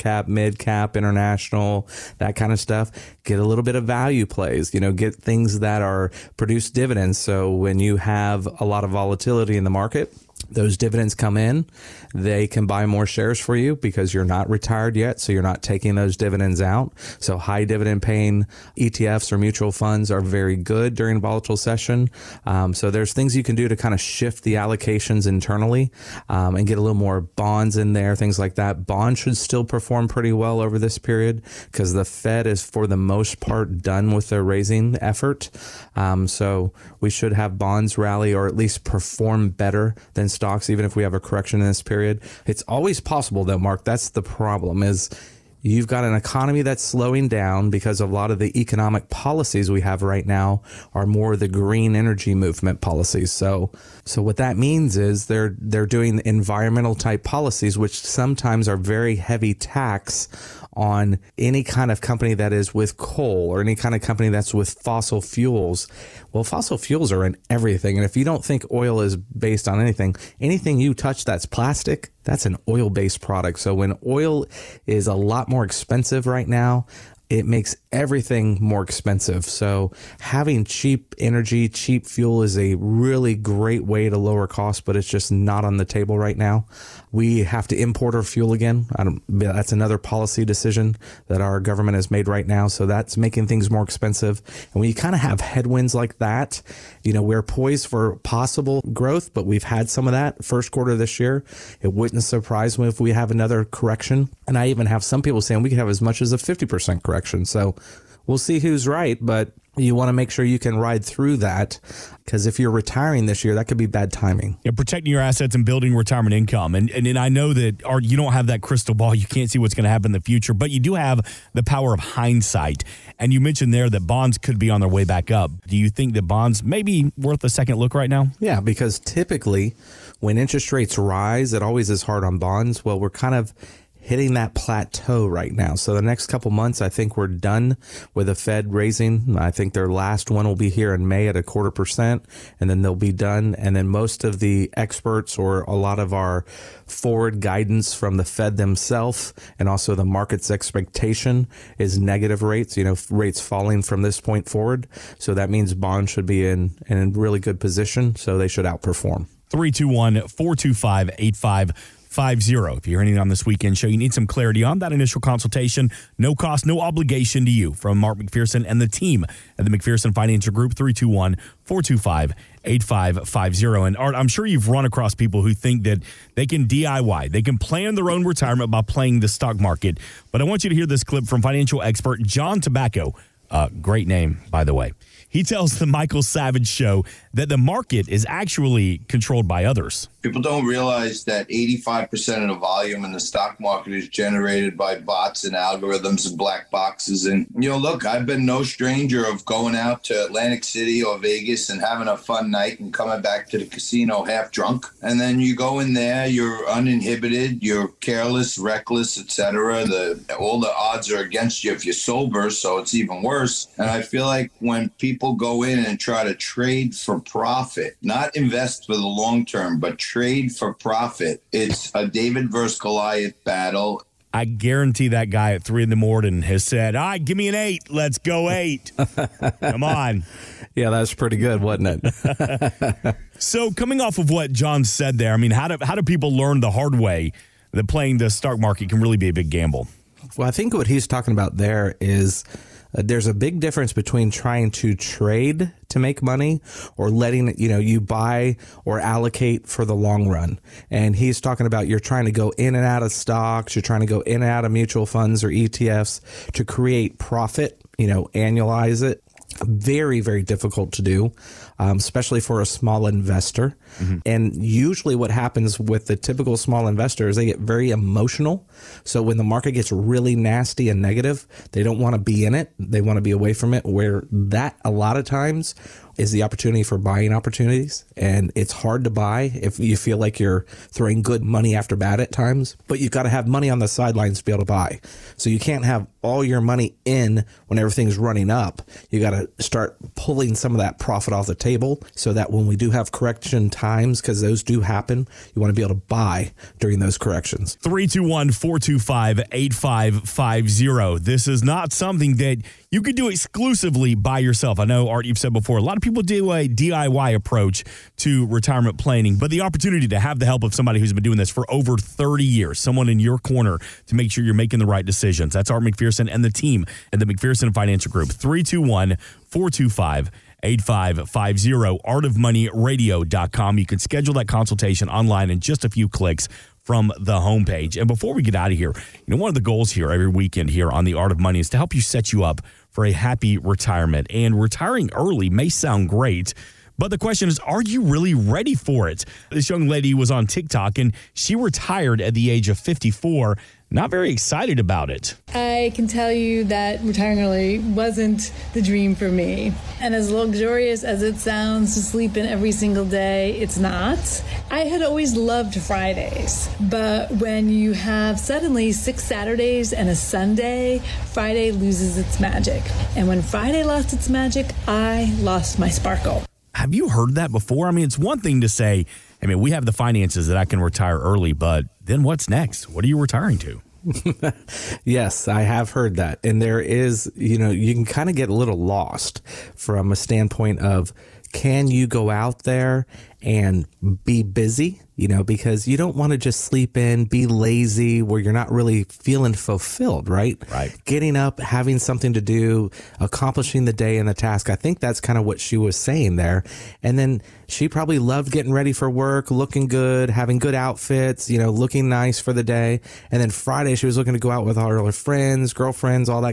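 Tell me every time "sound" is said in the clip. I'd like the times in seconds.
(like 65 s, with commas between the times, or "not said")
335 s, 351 s.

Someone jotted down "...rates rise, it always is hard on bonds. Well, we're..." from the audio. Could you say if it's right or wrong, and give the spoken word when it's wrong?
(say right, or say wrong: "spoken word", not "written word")
right.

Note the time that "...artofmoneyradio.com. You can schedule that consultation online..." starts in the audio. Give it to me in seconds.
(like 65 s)
322 s.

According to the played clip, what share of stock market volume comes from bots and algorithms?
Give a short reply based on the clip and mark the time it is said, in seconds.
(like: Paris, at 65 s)
85%, at 191 s.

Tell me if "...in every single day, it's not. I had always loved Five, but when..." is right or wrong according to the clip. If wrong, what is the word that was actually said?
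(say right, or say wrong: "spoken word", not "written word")
wrong: "Fridays", not "Five".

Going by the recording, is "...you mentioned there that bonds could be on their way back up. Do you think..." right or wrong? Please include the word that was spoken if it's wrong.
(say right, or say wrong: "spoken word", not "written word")
right.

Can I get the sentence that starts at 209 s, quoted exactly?
The all the odds are against you if you're sober, so it's even worse.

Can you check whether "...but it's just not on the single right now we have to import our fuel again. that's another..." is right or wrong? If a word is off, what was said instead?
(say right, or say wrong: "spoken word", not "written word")
wrong: "table", not "single".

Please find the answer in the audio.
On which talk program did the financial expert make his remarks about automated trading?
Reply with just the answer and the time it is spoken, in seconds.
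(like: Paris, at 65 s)
Michael Savage show, at 185 s.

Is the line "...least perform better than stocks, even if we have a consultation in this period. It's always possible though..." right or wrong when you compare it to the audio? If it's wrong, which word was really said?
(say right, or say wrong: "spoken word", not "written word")
wrong: "correction", not "consultation".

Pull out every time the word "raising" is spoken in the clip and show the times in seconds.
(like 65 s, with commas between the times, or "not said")
34 s, 138 s.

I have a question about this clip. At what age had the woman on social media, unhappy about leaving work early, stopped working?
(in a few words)
54.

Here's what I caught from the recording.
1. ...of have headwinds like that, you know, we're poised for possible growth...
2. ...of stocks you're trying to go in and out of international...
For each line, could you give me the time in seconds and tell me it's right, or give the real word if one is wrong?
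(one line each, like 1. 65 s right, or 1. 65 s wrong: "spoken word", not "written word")
1. 95 s right
2. 253 s wrong: "mutual", not "international".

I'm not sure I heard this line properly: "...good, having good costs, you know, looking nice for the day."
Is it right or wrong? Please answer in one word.
wrong.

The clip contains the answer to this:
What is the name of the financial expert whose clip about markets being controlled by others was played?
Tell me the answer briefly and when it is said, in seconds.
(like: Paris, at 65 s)
John Tabacco, at 182 s.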